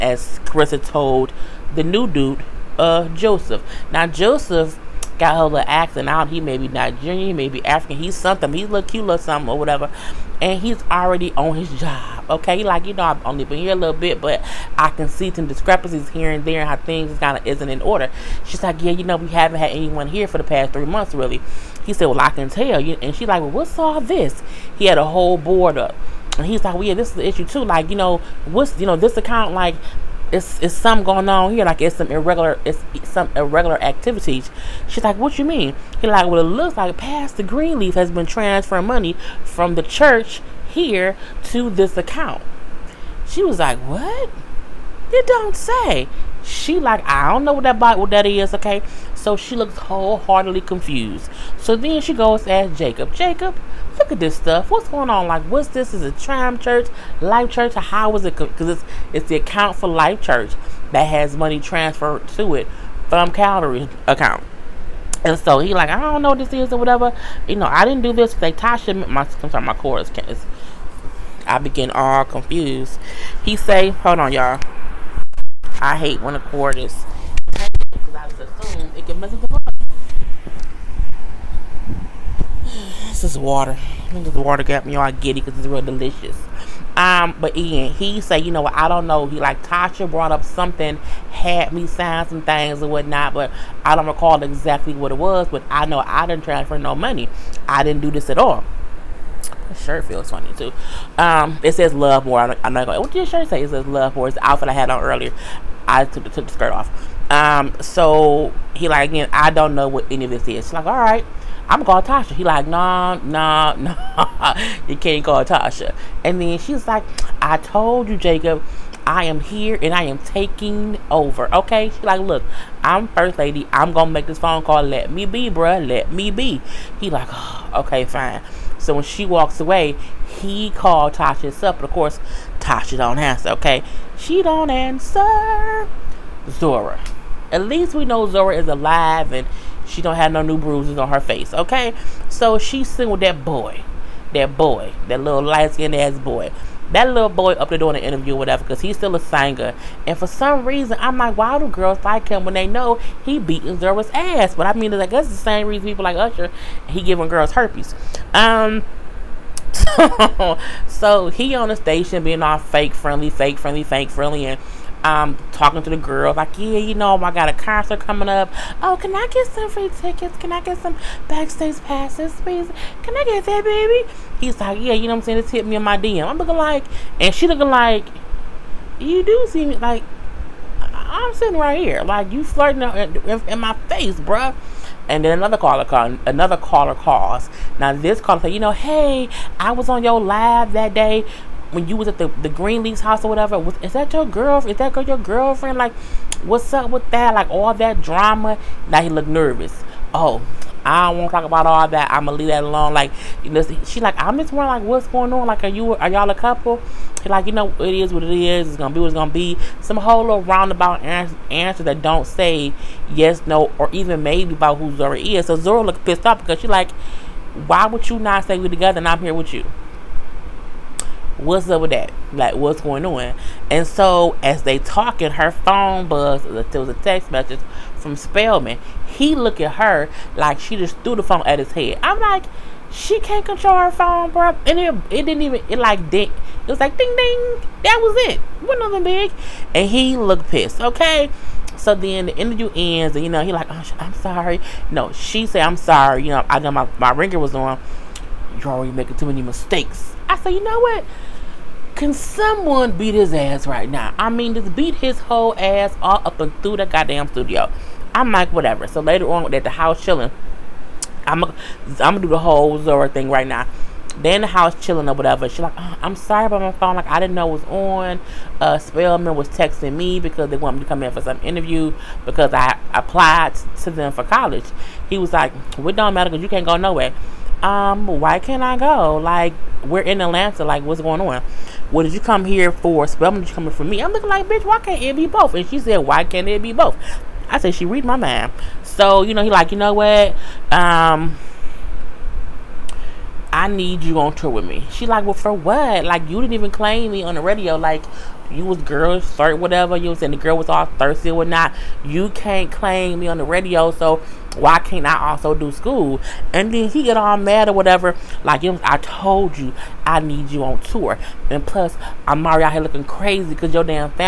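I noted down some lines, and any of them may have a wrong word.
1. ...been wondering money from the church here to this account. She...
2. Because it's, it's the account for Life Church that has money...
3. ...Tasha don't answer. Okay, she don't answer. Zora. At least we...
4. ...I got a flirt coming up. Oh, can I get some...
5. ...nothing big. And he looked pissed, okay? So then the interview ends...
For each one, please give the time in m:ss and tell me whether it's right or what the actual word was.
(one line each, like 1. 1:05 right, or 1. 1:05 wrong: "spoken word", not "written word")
1. 0:38 wrong: "transferring", not "wondering"
2. 0:58 right
3. 2:12 right
4. 2:47 wrong: "concert", not "flirt"
5. 3:58 right.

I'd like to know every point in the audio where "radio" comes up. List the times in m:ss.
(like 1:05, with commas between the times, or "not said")
4:57, 5:03.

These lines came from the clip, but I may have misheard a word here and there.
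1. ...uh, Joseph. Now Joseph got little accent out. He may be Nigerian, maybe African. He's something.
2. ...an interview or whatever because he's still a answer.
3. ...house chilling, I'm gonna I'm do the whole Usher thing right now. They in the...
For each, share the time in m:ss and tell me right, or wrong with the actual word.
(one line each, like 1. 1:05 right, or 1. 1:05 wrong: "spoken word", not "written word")
1. 0:02 right
2. 2:27 wrong: "singer", not "answer"
3. 4:19 wrong: "Zora", not "Usher".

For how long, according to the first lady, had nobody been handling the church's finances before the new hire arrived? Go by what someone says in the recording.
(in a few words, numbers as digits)
3 months.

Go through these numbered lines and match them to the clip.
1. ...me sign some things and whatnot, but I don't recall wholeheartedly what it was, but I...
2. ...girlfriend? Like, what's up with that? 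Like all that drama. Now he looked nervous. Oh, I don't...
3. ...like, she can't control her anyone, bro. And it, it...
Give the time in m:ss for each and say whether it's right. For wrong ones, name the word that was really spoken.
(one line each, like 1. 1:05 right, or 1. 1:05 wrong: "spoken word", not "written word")
1. 1:31 wrong: "exactly", not "wholeheartedly"
2. 3:15 right
3. 3:52 wrong: "phone", not "anyone".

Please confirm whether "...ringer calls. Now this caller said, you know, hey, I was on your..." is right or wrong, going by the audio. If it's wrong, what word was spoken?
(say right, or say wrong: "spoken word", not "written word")
wrong: "caller", not "ringer".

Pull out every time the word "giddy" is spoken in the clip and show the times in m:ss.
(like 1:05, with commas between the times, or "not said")
1:25.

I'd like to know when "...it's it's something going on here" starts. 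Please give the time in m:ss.
0:30.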